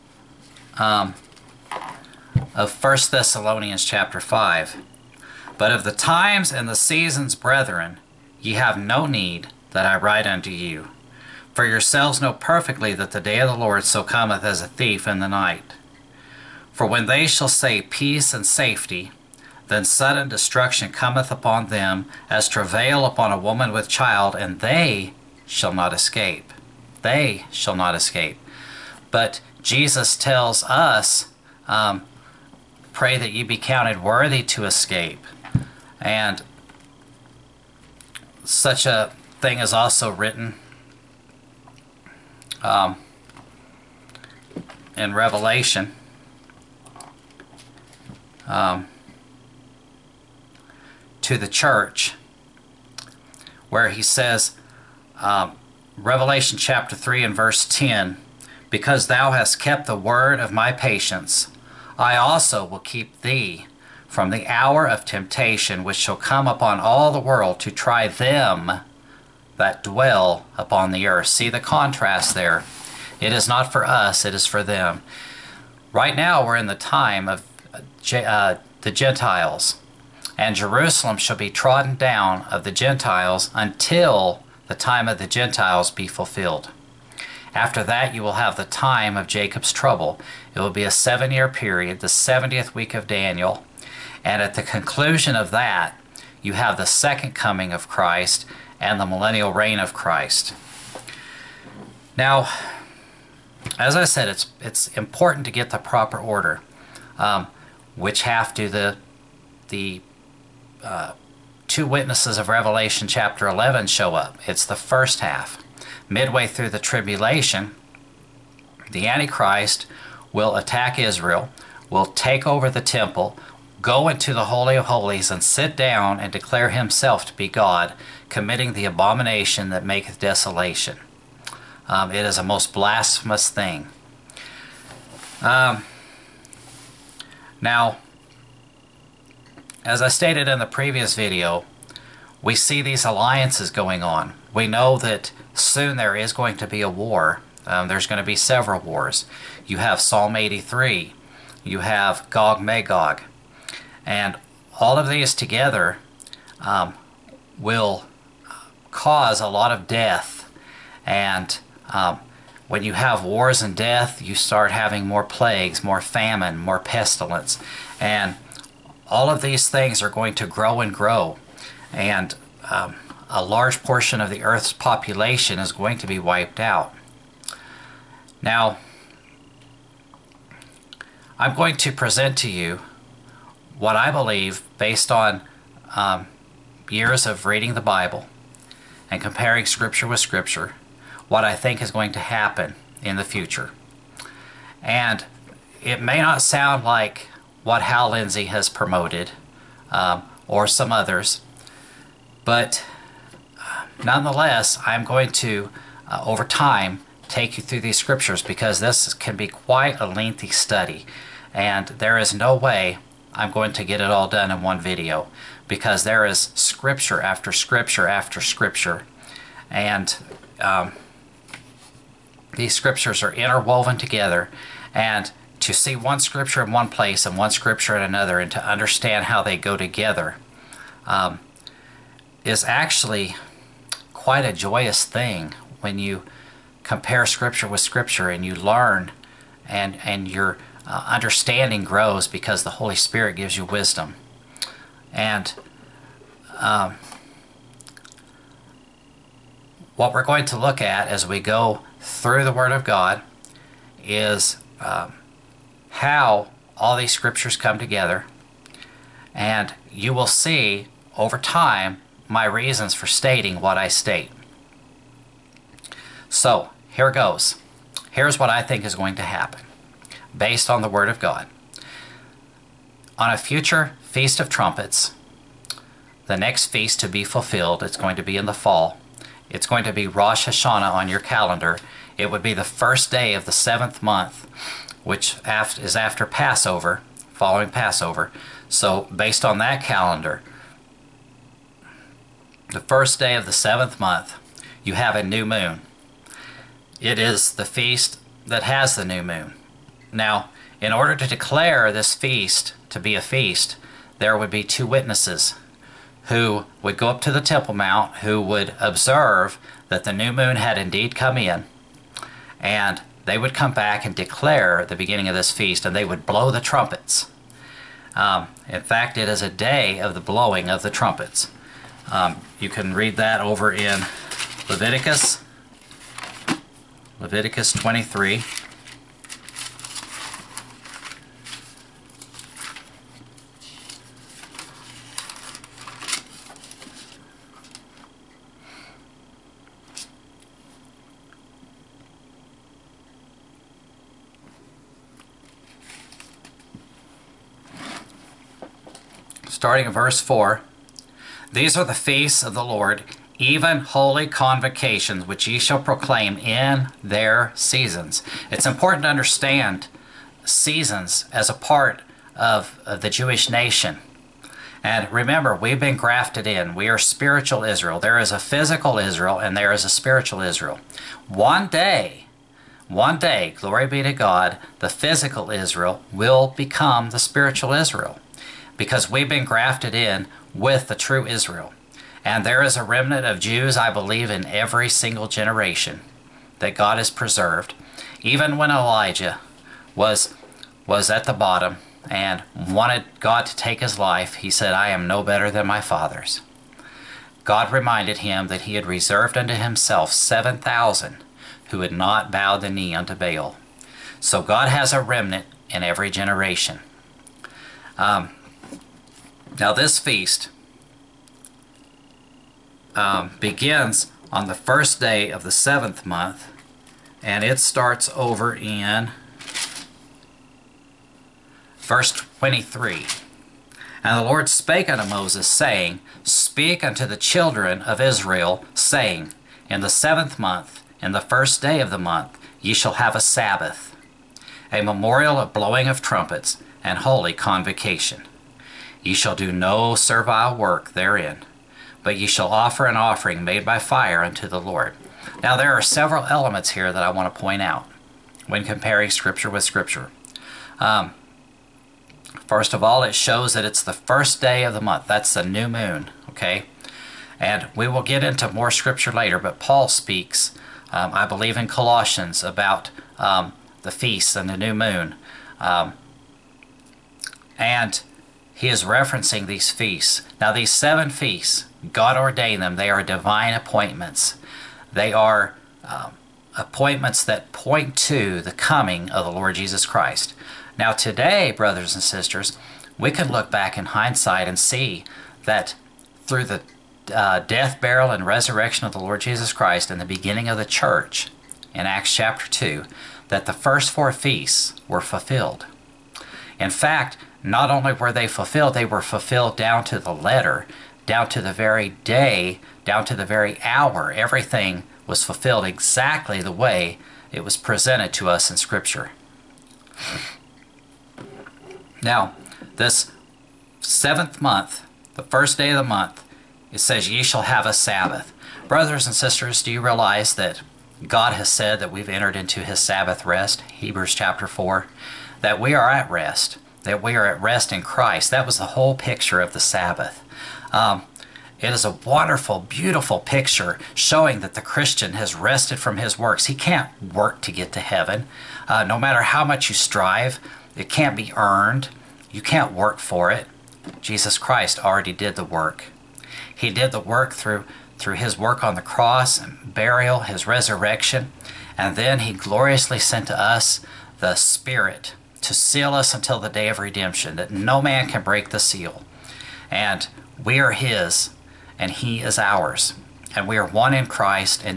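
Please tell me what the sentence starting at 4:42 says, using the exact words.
It would be the first day of the seventh month which is after Passover, following Passover.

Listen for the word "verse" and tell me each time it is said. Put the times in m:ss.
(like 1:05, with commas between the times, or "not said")
0:57, 5:49, 7:01.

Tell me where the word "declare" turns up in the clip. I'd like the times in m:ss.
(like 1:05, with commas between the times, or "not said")
2:06, 5:01, 5:14.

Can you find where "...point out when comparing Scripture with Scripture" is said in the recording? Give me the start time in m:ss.
7:27.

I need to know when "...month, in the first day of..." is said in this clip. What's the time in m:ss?
7:10.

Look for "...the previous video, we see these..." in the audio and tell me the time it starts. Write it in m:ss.
2:20.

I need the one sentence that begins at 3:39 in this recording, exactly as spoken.
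And um, these scriptures are interwoven together.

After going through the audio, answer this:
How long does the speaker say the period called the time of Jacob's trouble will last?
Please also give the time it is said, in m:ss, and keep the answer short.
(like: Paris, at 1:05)
7 years, at 1:30.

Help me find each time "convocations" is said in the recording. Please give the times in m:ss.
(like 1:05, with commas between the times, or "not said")
5:54, 7:17.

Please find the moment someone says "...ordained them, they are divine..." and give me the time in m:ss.
7:52.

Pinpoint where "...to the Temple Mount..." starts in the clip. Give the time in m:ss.
5:07.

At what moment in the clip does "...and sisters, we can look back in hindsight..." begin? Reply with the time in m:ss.
8:01.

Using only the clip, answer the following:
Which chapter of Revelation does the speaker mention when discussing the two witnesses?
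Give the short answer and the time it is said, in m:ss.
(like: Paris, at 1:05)
Chapter 11, at 1:52.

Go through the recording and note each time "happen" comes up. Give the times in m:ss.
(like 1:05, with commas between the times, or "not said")
3:12, 4:29.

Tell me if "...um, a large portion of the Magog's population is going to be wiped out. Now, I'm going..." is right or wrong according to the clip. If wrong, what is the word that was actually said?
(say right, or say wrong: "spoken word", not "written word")
wrong: "Earth", not "Magog".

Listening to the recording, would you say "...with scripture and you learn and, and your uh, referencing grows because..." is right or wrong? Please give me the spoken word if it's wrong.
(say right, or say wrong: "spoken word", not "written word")
wrong: "understanding", not "referencing".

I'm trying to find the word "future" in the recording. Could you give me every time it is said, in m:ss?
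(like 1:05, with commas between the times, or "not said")
3:13, 4:33.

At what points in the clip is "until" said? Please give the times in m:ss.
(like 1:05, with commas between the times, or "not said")
1:23, 9:16.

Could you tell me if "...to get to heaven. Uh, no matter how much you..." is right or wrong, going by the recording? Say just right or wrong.
right.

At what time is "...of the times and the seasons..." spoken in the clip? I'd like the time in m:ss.
0:05.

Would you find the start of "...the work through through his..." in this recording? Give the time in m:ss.
9:06.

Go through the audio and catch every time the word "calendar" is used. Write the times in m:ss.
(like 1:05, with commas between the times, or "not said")
4:41, 4:49.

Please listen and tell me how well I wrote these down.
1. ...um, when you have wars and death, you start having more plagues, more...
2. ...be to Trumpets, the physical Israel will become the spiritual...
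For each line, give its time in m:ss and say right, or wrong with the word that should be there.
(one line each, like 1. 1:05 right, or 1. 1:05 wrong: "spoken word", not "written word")
1. 2:41 right
2. 6:13 wrong: "God", not "Trumpets".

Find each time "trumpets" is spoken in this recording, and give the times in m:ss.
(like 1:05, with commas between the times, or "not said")
4:34, 5:16, 5:20, 7:16.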